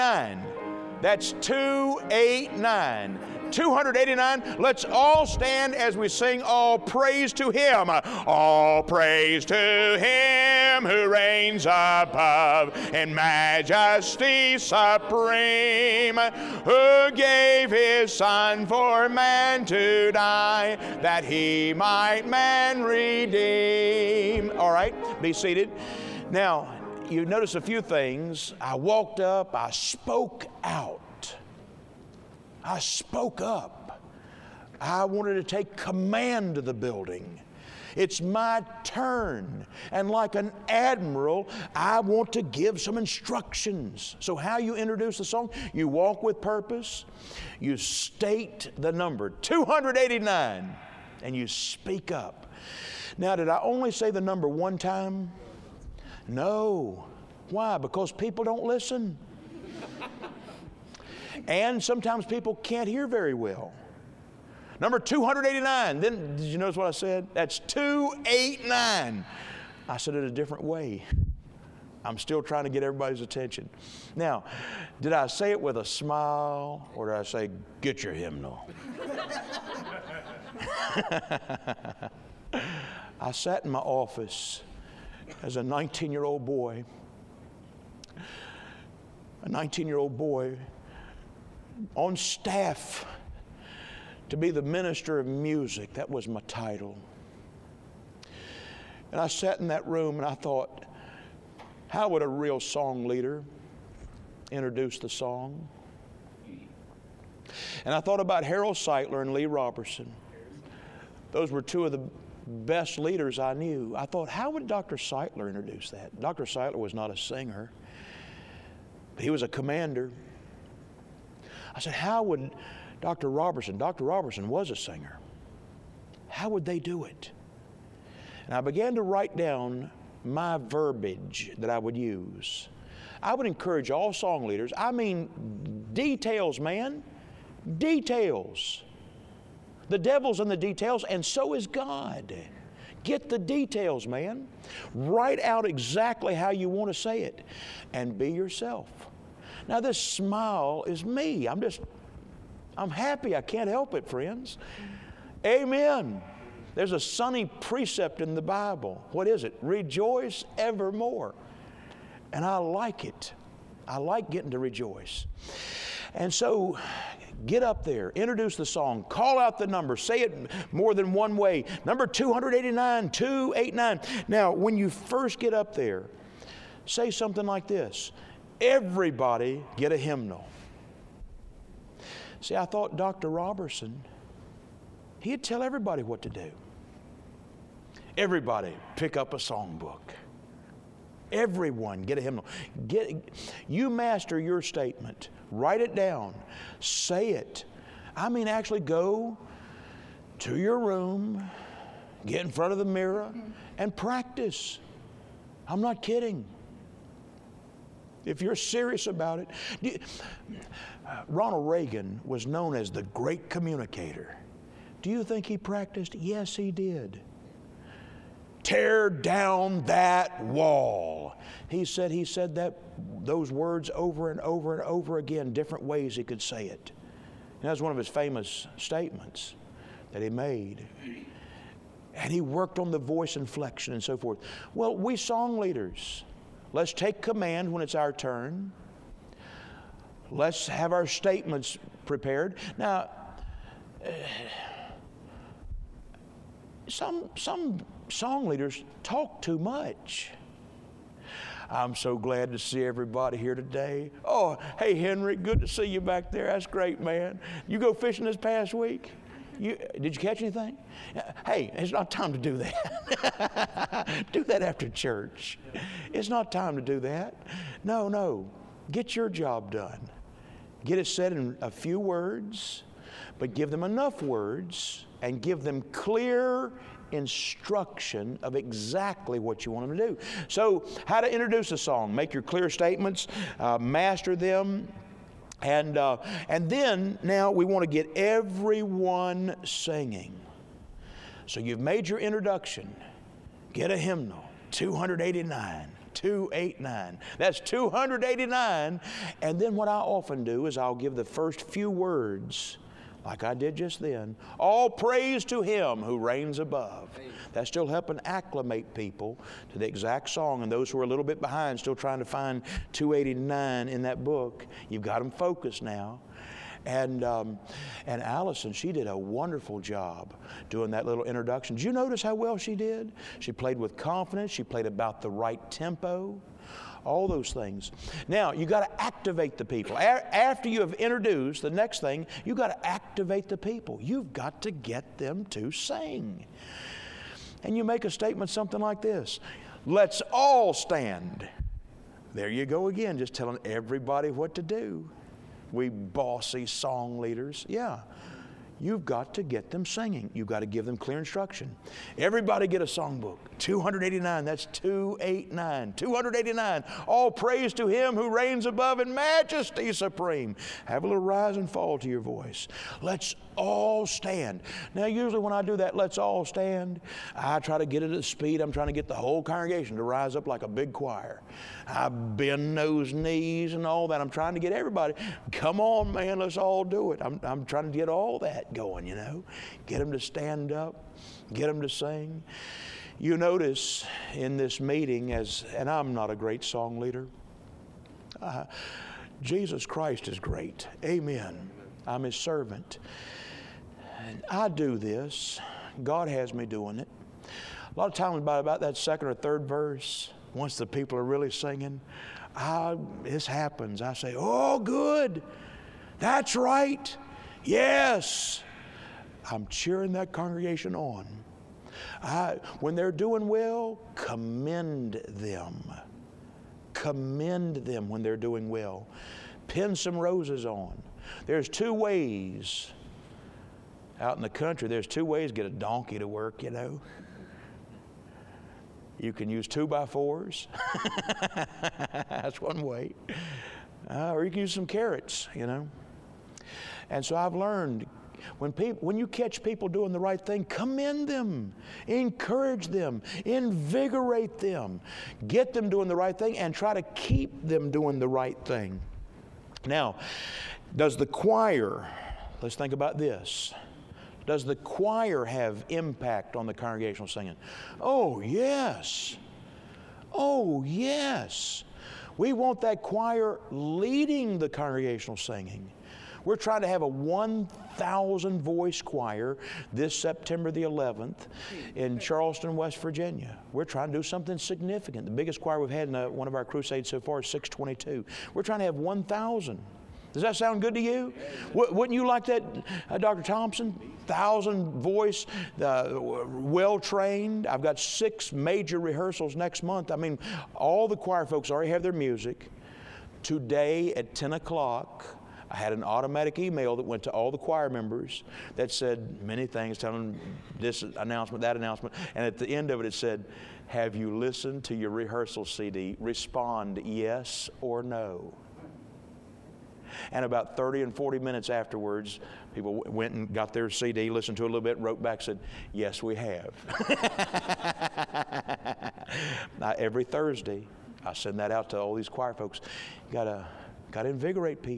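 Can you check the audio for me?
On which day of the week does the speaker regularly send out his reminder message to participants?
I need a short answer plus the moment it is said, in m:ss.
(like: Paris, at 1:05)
Thursday, at 8:40.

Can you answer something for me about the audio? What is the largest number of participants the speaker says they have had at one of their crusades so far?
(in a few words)
622.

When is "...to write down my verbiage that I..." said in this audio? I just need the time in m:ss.
2:08.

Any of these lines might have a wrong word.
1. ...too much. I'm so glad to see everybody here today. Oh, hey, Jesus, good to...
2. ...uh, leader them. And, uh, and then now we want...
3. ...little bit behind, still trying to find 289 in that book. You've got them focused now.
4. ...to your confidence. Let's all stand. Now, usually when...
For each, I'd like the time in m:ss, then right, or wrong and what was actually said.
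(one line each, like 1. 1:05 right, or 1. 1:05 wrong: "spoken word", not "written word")
1. 4:09 wrong: "Henry", not "Jesus"
2. 4:43 wrong: "master", not "leader"
3. 5:11 right
4. 6:01 wrong: "voice", not "confidence".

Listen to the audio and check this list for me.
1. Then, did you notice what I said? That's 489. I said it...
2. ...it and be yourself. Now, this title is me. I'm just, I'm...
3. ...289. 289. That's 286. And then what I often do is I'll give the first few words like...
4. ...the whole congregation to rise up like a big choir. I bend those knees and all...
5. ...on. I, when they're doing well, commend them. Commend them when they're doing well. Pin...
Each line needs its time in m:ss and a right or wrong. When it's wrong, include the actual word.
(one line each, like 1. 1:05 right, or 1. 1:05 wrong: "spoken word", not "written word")
1. 1:05 wrong: "289", not "489"
2. 2:27 wrong: "smile", not "title"
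3. 4:54 wrong: "289", not "286"
4. 6:09 right
5. 6:50 right.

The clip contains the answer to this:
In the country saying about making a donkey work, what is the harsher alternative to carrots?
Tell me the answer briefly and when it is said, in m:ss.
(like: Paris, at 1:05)
Two by fours, at 7:09.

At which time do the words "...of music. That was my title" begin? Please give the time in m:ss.
1:35.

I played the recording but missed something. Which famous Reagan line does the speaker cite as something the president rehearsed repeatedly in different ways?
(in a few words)
Tear down that wall.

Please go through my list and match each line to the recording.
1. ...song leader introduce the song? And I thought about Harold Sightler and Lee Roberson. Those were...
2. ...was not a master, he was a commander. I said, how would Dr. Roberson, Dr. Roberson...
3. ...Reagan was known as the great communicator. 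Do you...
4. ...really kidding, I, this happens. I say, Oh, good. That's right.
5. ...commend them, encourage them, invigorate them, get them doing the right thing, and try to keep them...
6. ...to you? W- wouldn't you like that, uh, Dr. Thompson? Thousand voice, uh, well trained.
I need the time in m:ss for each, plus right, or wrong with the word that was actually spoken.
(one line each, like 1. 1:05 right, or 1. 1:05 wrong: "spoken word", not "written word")
1. 1:42 right
2. 1:56 wrong: "singer", not "master"
3. 3:31 right
4. 6:41 wrong: "singing", not "kidding"
5. 7:20 right
6. 8:00 right.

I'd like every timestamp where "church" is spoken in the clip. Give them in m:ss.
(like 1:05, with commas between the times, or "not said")
4:24.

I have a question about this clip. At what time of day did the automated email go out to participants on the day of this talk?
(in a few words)
10 o'clock.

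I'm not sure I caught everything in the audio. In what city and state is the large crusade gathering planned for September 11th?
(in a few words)
Charleston, West Virginia.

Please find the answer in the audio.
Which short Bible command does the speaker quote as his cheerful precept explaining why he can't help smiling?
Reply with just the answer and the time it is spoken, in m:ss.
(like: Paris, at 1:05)
Rejoice evermore, at 2:39.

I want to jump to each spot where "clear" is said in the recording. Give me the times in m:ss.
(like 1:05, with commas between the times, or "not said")
4:35, 4:42, 5:50.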